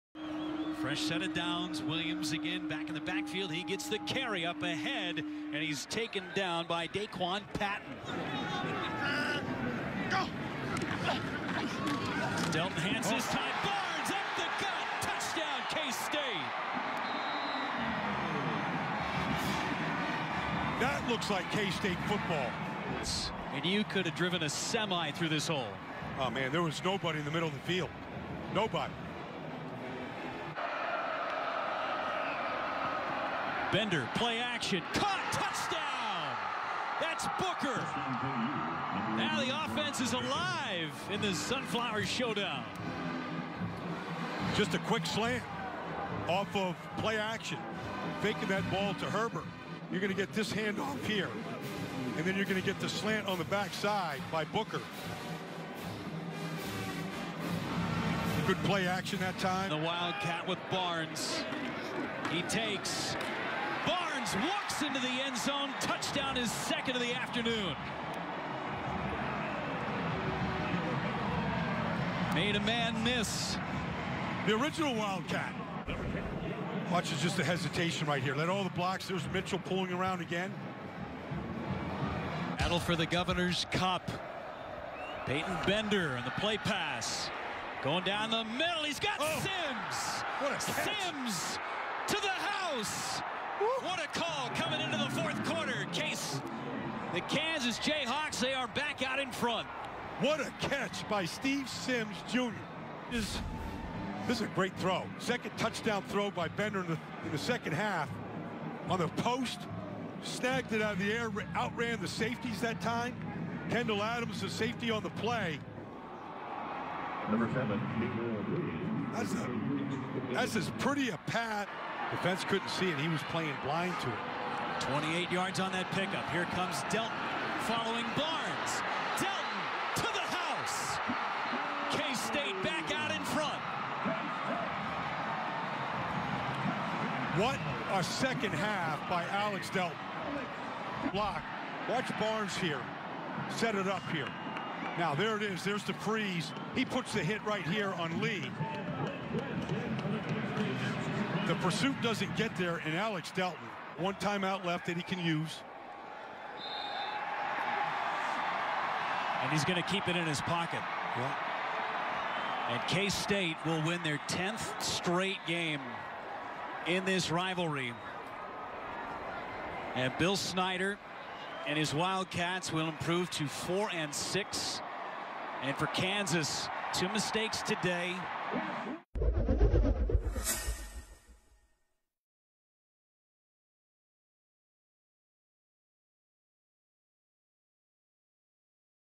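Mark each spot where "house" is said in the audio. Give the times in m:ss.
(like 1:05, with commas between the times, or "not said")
1:32, 2:10.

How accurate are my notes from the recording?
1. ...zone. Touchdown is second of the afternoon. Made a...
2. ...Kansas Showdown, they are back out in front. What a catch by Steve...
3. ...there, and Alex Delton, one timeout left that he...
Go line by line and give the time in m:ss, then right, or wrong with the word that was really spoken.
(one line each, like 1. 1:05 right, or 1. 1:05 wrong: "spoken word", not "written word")
1. 1:05 right
2. 1:37 wrong: "Jayhawks", not "Showdown"
3. 2:32 right.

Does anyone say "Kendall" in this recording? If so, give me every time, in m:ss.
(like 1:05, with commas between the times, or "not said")
1:53.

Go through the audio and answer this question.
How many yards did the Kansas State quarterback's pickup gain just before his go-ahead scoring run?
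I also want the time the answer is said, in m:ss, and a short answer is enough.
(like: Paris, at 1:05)
28, at 2:04.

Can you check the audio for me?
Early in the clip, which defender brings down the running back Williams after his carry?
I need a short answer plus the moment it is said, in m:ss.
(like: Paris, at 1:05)
Daquan Patton, at 0:06.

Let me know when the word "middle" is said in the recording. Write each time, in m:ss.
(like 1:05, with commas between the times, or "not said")
0:27, 1:28.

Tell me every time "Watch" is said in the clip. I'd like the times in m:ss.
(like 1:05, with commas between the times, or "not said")
1:16, 2:21.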